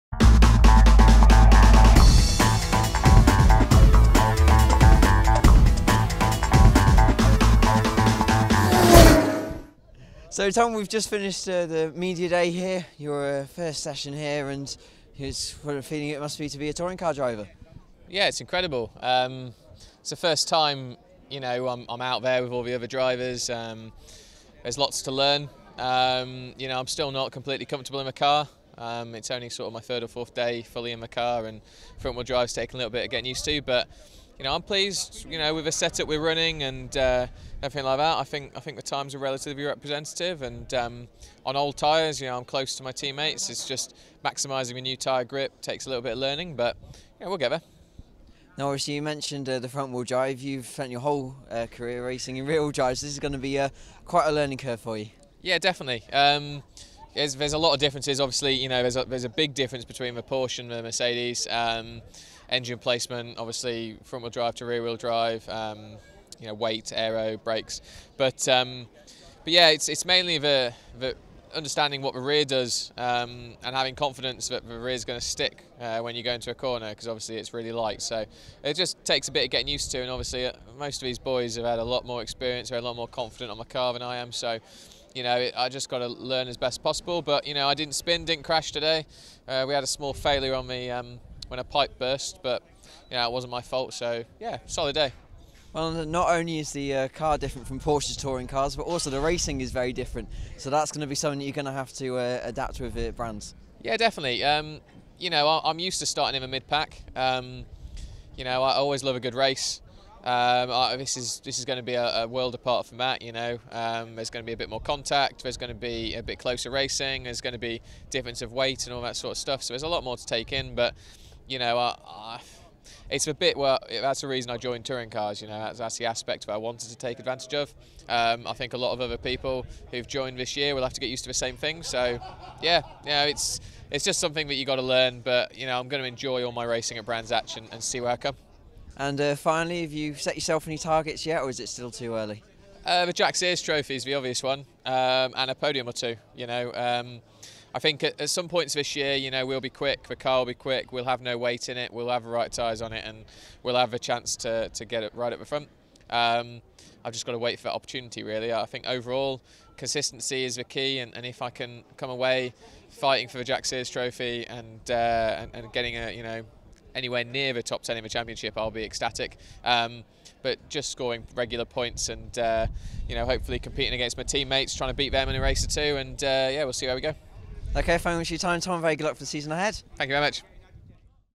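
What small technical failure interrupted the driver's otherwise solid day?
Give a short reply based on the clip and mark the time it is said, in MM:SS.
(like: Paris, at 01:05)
A pipe burst, at 01:31.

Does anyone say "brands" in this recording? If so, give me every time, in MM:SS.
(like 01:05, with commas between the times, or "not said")
01:43, 02:17.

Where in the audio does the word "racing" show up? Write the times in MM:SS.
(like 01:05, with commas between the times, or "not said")
00:52, 01:39, 01:56, 02:16.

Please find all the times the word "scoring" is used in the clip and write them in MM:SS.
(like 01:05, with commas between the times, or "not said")
02:50.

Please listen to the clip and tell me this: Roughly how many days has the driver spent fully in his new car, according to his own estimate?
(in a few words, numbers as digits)
3 or 4.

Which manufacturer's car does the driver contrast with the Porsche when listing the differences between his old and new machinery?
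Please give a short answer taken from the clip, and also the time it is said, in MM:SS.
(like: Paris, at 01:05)
Mercedes, at 01:00.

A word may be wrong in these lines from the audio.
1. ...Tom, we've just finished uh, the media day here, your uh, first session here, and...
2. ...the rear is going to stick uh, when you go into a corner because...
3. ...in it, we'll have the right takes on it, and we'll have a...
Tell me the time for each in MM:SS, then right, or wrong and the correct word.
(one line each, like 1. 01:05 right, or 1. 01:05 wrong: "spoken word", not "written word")
1. 00:10 right
2. 01:14 right
3. 02:31 wrong: "tyres", not "takes".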